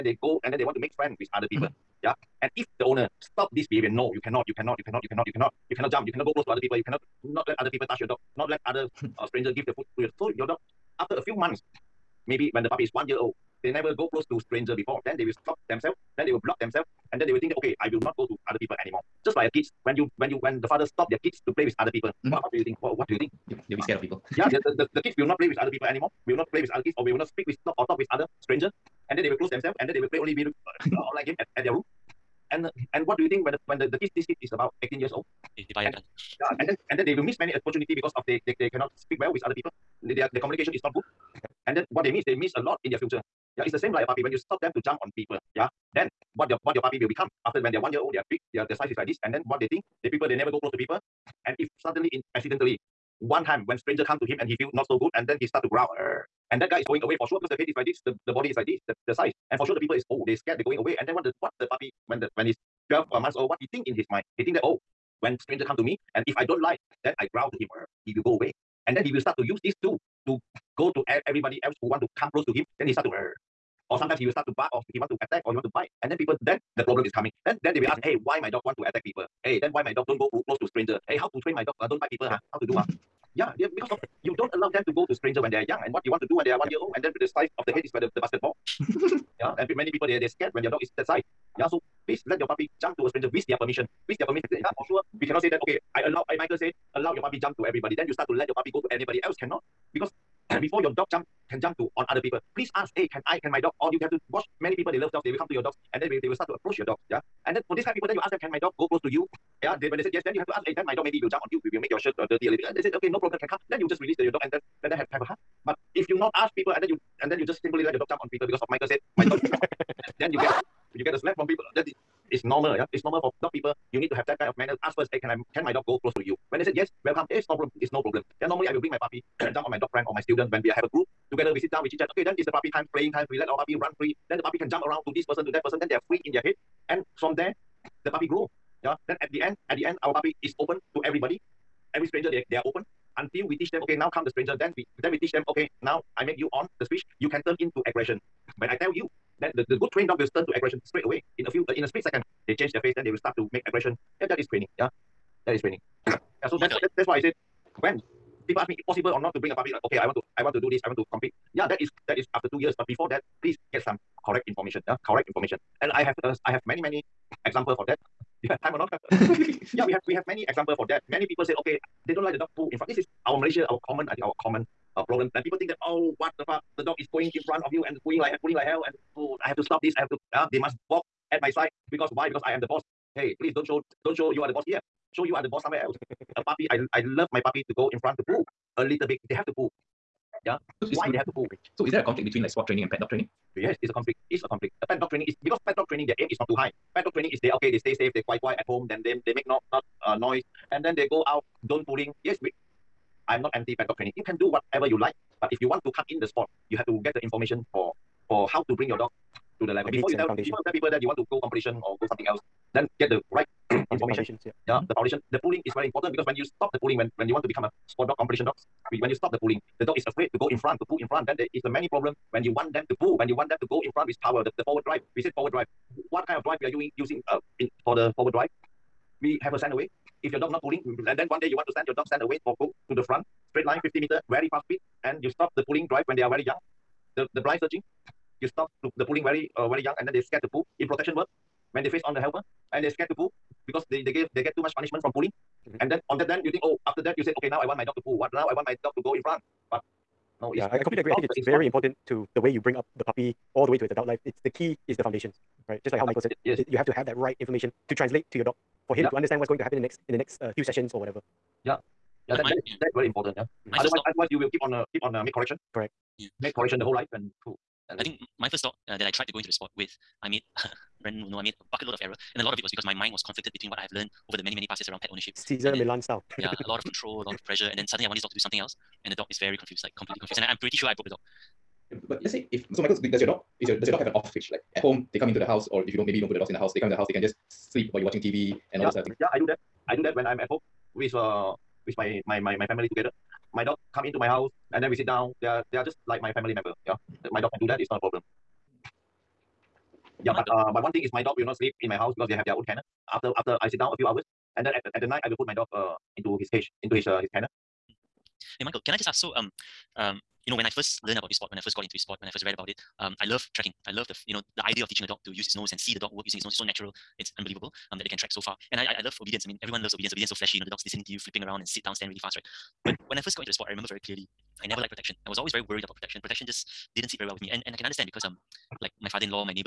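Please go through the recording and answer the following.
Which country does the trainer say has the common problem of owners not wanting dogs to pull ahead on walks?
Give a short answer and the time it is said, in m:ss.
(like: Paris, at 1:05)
Malaysia, at 2:53.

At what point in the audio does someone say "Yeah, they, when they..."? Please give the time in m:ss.
1:49.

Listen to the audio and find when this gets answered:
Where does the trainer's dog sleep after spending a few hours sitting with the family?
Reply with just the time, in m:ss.
5:07.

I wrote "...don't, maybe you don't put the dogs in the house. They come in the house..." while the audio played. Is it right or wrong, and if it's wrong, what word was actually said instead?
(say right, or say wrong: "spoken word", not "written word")
right.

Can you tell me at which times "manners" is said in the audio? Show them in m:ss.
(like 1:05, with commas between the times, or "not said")
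2:04.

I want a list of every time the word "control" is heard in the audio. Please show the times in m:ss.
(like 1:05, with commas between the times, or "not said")
4:36.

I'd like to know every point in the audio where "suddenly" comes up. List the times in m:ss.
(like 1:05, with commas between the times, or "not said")
0:51, 4:37.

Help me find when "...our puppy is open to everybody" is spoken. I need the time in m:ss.
2:20.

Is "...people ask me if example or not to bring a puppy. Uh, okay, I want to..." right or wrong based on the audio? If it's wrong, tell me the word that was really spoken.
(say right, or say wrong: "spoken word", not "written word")
wrong: "possible", not "example".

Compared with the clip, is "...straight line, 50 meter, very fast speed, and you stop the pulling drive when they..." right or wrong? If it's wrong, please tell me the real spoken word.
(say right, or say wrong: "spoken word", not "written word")
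right.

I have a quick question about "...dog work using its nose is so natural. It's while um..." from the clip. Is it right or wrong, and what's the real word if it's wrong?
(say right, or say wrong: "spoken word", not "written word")
wrong: "unbelievable", not "while".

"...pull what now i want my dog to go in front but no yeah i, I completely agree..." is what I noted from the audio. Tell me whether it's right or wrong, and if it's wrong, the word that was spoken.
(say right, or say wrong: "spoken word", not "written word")
right.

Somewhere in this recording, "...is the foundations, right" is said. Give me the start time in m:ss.
4:14.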